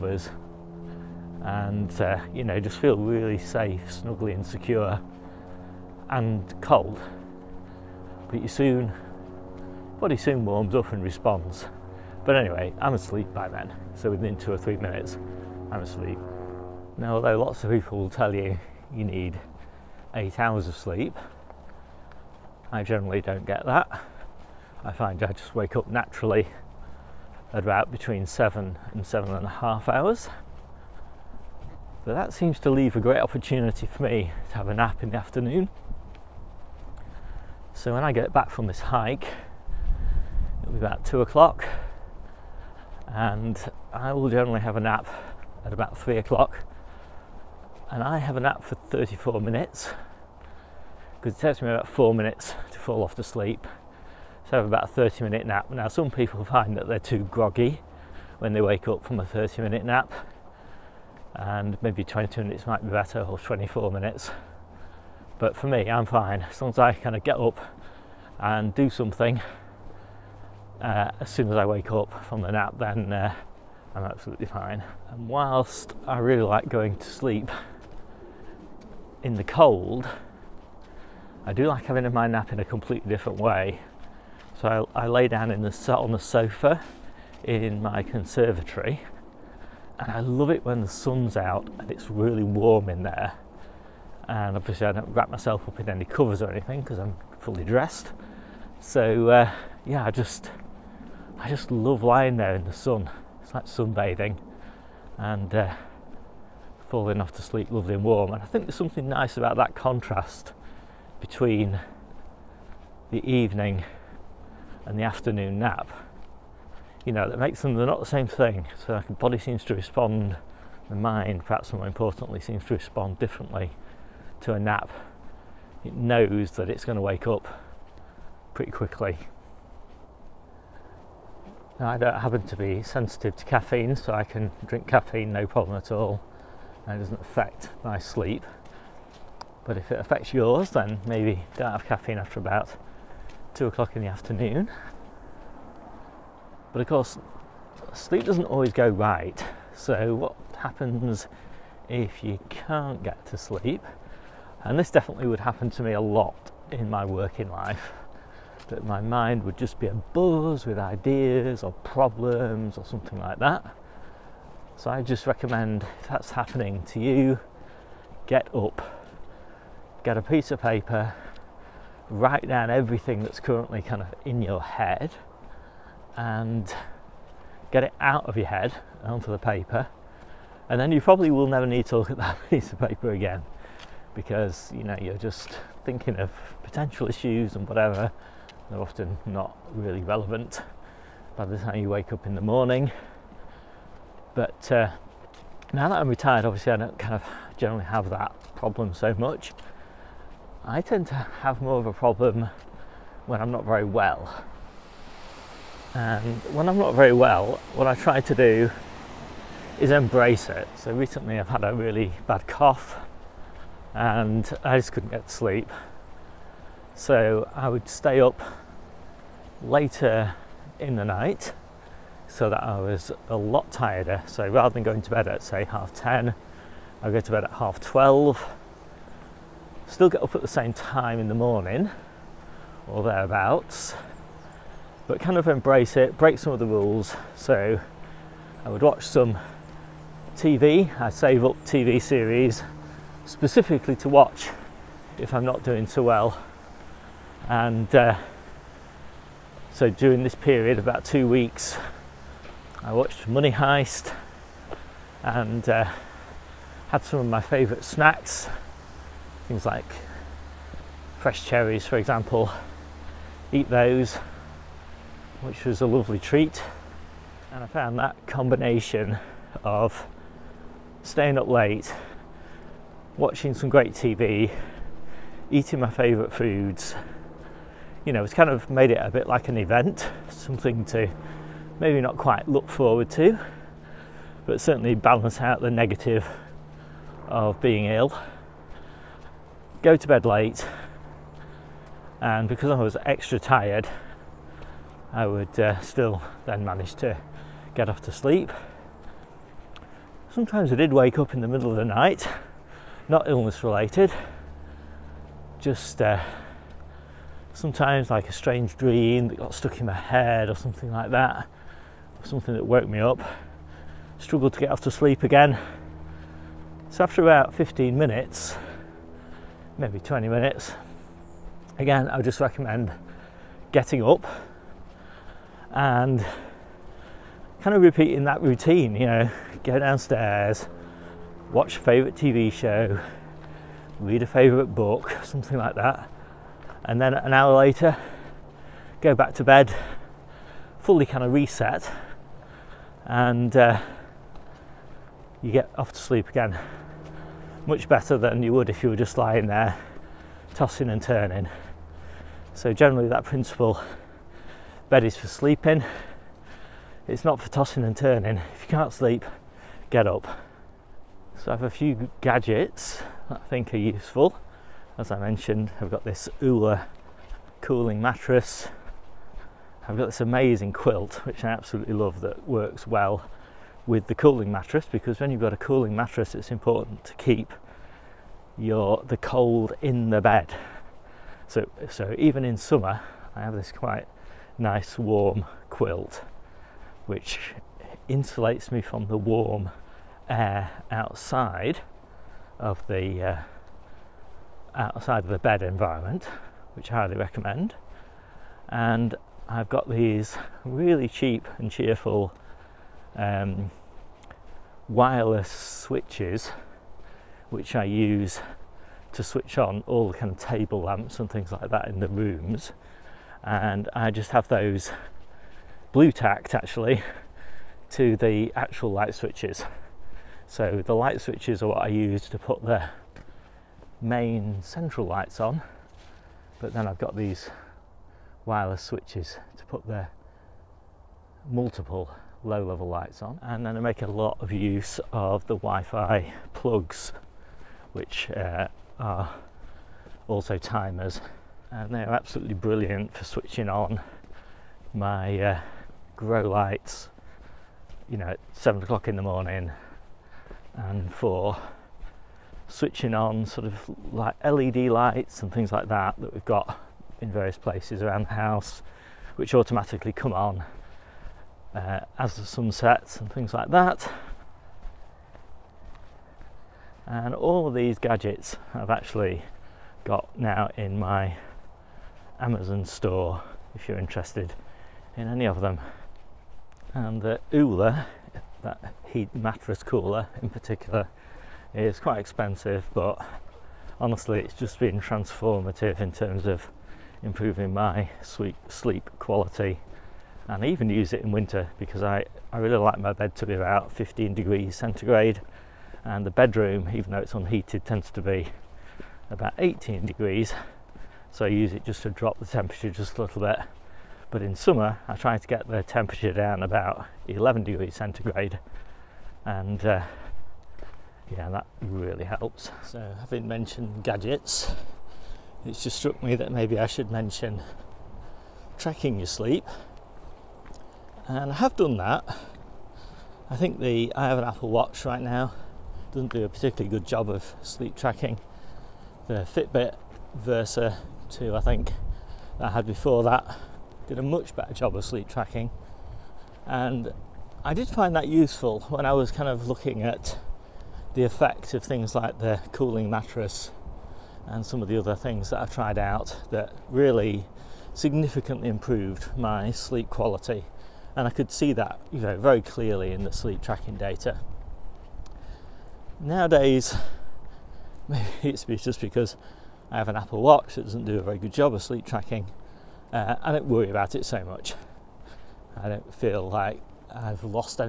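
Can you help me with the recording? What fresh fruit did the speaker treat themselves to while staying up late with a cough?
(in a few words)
cherries.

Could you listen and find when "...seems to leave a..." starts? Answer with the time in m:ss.
0:32.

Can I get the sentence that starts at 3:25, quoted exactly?
And when I'm not very well, what I try to do is embrace it.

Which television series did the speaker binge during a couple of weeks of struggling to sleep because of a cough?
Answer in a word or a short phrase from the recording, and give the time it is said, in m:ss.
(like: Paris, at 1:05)
Money Heist, at 4:13.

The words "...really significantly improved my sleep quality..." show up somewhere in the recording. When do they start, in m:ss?
9:06.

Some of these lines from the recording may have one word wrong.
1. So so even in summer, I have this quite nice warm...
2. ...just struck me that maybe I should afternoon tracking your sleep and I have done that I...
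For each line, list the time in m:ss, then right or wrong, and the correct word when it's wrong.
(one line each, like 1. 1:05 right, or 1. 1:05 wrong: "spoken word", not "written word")
1. 6:21 right
2. 8:35 wrong: "mention", not "afternoon".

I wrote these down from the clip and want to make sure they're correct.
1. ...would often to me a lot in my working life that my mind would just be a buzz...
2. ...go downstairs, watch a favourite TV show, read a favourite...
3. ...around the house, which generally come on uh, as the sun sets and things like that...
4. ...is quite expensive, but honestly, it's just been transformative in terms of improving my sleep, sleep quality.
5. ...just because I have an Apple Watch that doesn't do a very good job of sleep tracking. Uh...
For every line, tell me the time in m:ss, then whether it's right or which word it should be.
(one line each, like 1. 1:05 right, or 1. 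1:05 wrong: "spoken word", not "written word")
1. 2:35 wrong: "happen", not "often"
2. 5:29 right
3. 7:38 wrong: "automatically", not "generally"
4. 8:01 right
5. 9:18 right.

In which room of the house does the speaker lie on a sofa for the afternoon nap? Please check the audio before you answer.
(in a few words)
conservatory.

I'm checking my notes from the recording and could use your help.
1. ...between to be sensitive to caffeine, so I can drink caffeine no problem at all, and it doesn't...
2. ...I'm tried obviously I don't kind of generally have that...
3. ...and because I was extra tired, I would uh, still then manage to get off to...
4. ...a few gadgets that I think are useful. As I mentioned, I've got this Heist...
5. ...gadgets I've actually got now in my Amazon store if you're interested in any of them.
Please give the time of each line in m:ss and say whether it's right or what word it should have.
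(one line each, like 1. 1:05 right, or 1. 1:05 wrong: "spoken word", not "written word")
1. 2:12 wrong: "happen", not "between"
2. 3:16 wrong: "retired", not "tried"
3. 4:52 right
4. 6:01 wrong: "Ooler", not "Heist"
5. 7:47 right.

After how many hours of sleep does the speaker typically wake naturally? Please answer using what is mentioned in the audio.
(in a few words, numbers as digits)
7 to 7.5 hours.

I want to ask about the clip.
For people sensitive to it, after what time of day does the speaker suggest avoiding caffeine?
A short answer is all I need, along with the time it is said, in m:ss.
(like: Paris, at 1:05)
2 o'clock, at 2:23.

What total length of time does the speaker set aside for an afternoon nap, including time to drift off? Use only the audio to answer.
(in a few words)
34 minutes.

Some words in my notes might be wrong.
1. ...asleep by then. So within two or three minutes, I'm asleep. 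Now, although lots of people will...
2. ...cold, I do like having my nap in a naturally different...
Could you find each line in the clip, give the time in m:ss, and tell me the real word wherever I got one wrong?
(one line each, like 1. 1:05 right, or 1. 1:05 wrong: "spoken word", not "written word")
1. 0:12 right
2. 1:19 wrong: "completely", not "naturally".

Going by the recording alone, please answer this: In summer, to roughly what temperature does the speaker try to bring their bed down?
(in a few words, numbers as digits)
11 degrees centigrade.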